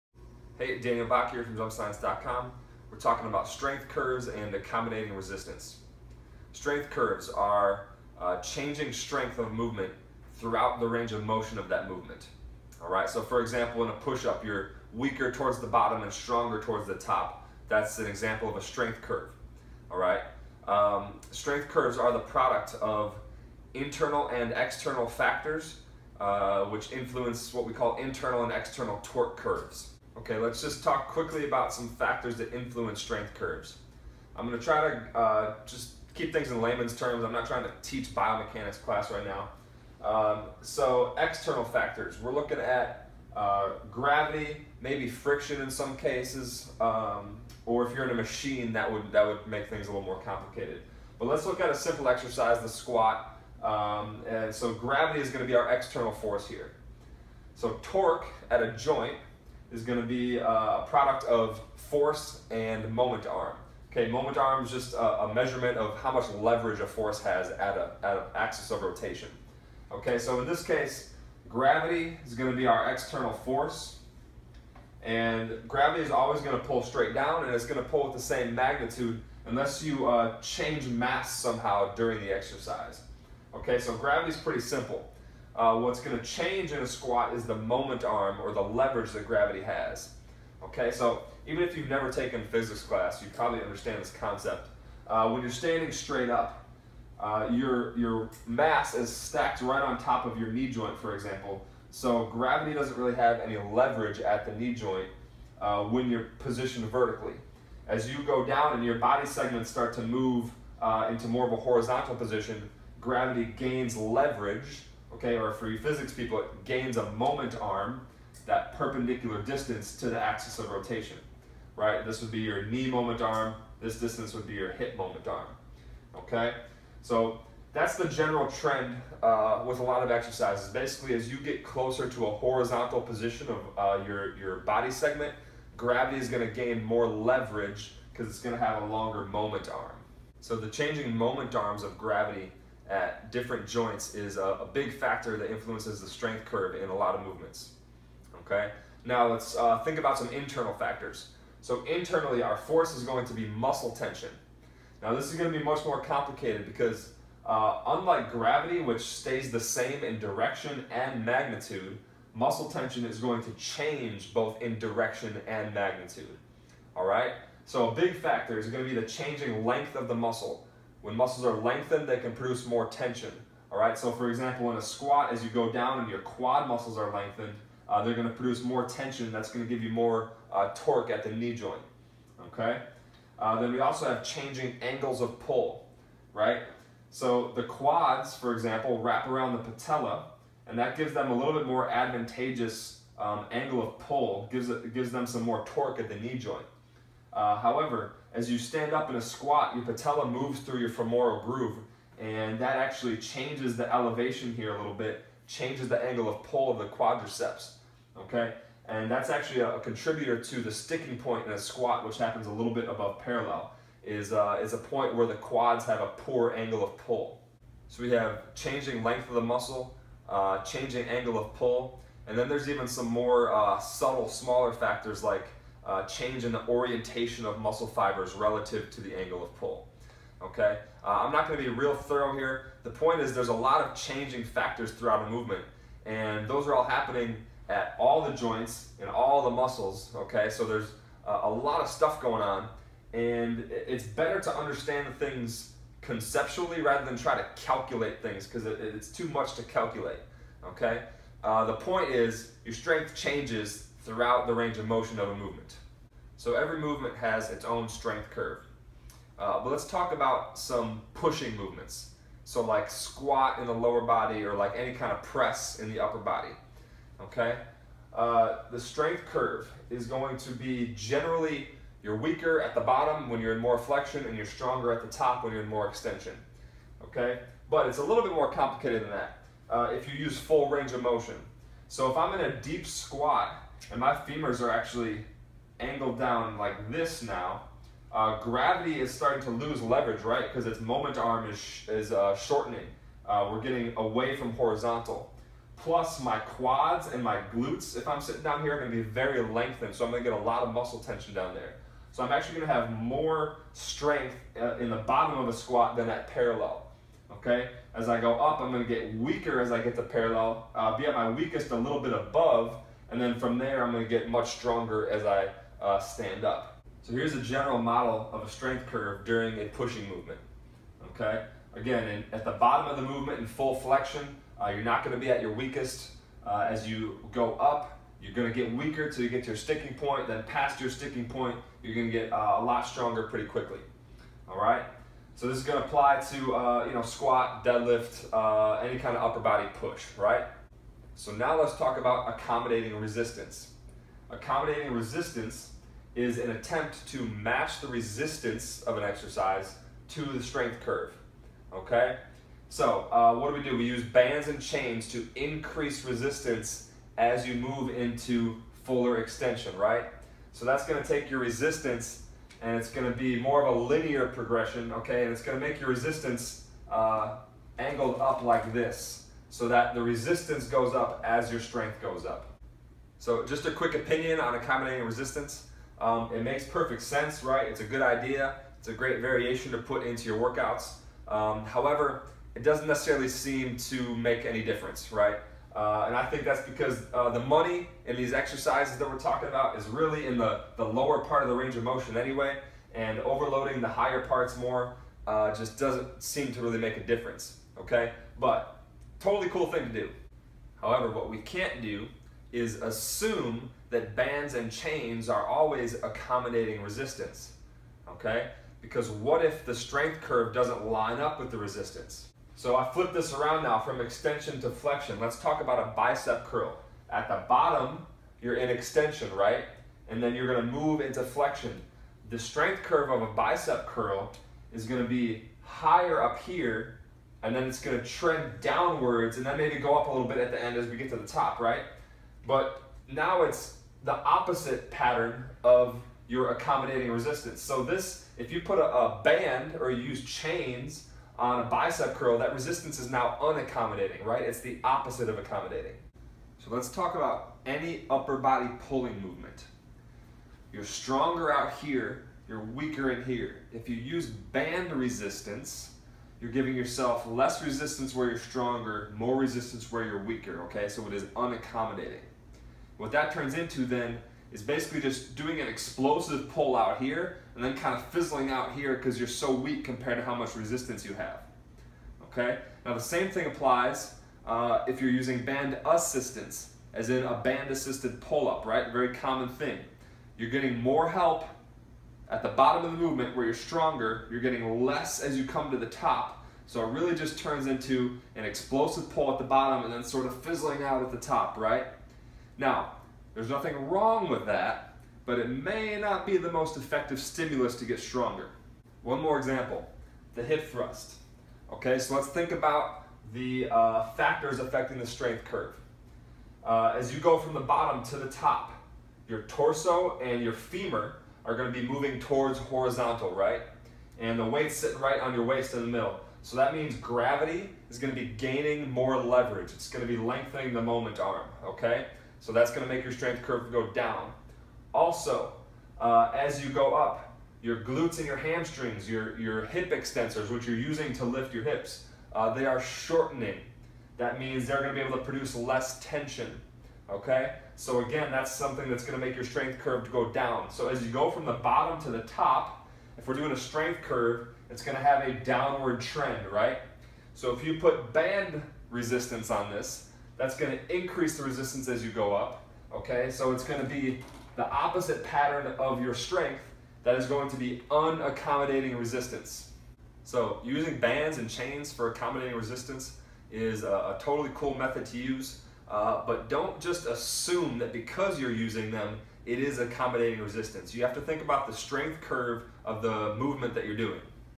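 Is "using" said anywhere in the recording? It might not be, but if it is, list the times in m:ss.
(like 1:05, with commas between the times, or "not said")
7:55, 8:50, 9:20, 9:28.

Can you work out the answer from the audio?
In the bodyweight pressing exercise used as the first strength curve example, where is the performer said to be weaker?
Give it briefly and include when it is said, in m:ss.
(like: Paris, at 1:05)
towards the bottom, at 0:14.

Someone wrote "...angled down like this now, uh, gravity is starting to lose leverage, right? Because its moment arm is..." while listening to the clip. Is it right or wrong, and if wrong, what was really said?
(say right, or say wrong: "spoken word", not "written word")
right.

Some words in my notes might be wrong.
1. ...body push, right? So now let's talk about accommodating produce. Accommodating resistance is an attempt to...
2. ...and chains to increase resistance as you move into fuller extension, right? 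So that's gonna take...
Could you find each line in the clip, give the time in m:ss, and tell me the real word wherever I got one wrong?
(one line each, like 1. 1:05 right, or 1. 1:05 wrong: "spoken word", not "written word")
1. 5:39 wrong: "resistance", not "produce"
2. 5:54 right.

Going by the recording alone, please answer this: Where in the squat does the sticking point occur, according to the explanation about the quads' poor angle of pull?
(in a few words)
a little bit above parallel.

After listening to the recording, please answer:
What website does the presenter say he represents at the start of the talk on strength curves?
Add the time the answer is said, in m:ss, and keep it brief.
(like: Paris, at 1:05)
JumpScience.com, at 0:01.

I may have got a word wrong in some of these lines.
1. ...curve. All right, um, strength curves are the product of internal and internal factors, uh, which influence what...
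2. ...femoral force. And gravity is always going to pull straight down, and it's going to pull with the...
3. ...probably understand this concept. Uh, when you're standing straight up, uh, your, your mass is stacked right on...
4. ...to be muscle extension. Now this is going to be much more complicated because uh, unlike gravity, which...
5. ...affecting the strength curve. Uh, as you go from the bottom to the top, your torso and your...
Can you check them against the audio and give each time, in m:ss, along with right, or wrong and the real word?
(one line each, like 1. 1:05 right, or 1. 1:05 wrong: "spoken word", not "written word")
1. 0:19 wrong: "external", not "internal"
2. 1:12 wrong: "external", not "femoral"
3. 1:33 right
4. 2:33 wrong: "tension", not "extension"
5. 8:24 right.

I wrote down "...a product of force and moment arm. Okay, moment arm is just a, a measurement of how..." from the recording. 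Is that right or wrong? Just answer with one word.
right.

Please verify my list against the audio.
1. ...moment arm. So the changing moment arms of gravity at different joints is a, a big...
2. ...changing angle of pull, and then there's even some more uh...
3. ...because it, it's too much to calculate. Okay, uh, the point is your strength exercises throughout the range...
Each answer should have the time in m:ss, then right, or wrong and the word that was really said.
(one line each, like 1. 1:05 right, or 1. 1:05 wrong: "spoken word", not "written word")
1. 2:19 right
2. 3:40 right
3. 4:08 wrong: "changes", not "exercises".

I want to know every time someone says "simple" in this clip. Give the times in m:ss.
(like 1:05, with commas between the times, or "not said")
0:51, 1:24.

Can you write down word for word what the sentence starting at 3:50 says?
Okay, uh, I'm not going to be real thorough here.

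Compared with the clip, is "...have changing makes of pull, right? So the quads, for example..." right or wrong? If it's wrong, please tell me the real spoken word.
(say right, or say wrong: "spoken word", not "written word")
wrong: "angles", not "makes".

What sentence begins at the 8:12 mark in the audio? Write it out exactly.
Now, there's nothing wrong with that, but it may not be the most effective stimulus to get stronger.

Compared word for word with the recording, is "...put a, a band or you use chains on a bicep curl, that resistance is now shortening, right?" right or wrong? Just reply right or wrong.
wrong.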